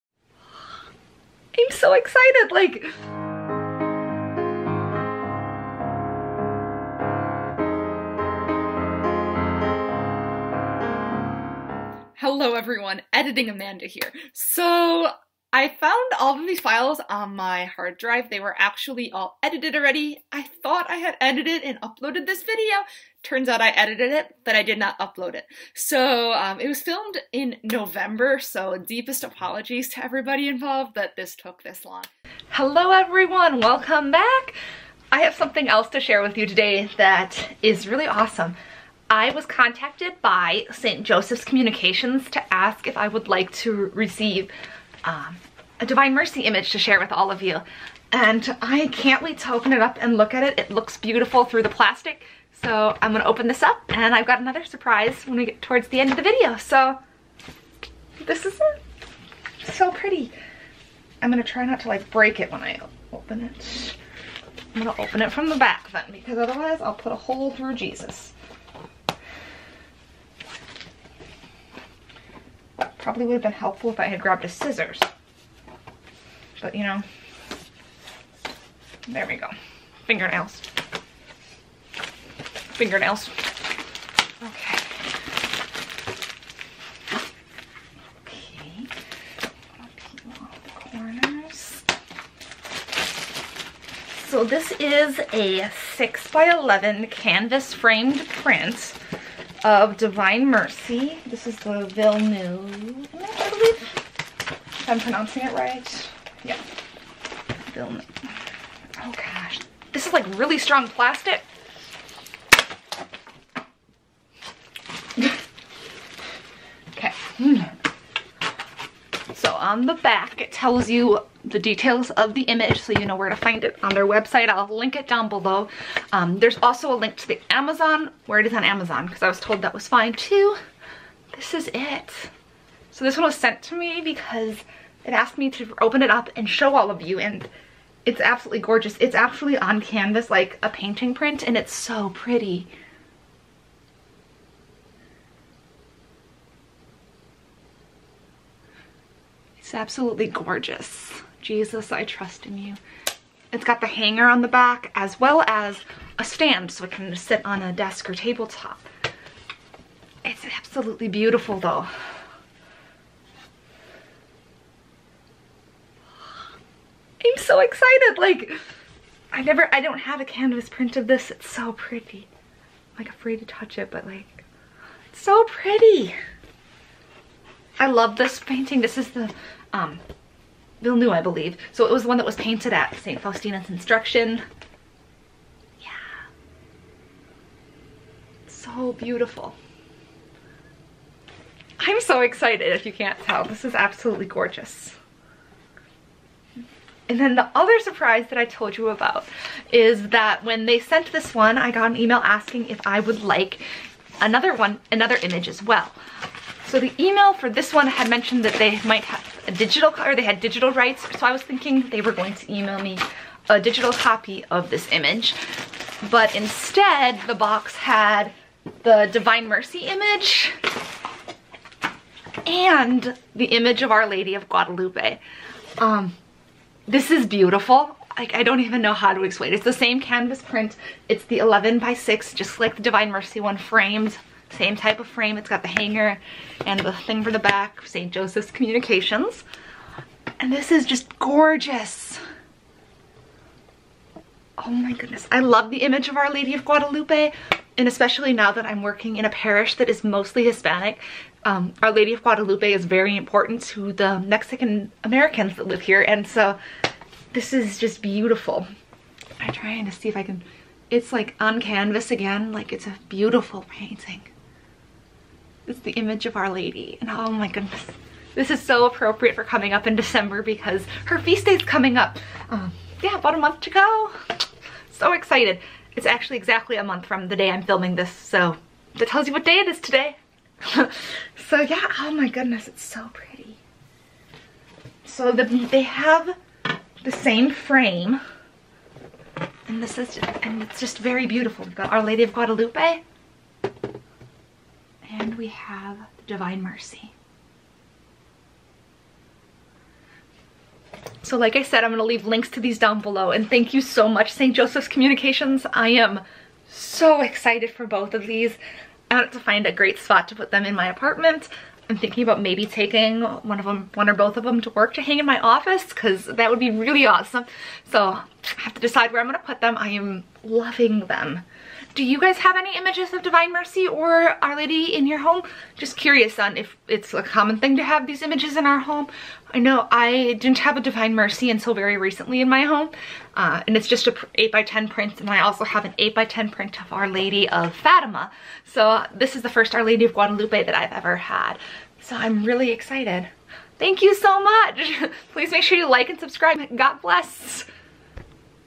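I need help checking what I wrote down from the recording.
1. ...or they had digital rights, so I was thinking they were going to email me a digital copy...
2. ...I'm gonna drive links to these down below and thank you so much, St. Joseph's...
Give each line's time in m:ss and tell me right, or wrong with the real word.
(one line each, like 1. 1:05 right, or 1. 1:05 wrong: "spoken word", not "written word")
1. 3:30 right
2. 5:01 wrong: "leave", not "drive".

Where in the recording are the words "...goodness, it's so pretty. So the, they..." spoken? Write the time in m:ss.
4:42.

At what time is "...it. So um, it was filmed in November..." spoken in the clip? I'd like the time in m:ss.
0:25.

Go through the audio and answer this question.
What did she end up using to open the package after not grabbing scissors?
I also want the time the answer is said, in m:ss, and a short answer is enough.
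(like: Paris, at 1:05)
Fingernails, at 1:20.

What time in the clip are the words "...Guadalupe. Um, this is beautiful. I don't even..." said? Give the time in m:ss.
3:44.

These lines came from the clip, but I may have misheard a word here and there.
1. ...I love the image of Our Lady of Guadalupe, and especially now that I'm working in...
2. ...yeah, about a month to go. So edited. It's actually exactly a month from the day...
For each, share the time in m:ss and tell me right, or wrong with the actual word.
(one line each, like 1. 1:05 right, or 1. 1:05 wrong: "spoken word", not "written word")
1. 4:05 right
2. 4:33 wrong: "excited", not "edited".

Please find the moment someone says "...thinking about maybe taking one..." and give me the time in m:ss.
5:11.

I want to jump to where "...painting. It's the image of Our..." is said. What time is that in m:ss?
4:23.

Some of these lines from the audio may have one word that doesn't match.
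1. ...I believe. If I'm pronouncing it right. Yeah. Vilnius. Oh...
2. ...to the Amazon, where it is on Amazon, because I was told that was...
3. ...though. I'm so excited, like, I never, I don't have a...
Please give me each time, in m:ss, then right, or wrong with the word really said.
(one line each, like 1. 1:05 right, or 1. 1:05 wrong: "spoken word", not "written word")
1. 1:43 right
2. 2:07 right
3. 2:41 right.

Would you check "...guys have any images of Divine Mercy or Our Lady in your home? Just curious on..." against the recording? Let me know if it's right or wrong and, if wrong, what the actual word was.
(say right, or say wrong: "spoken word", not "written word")
right.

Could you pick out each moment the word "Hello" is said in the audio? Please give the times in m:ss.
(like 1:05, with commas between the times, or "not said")
0:12, 0:32.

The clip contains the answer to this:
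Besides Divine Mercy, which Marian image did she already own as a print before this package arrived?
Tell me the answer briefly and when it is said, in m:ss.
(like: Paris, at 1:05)
Our Lady of Fatima, at 5:36.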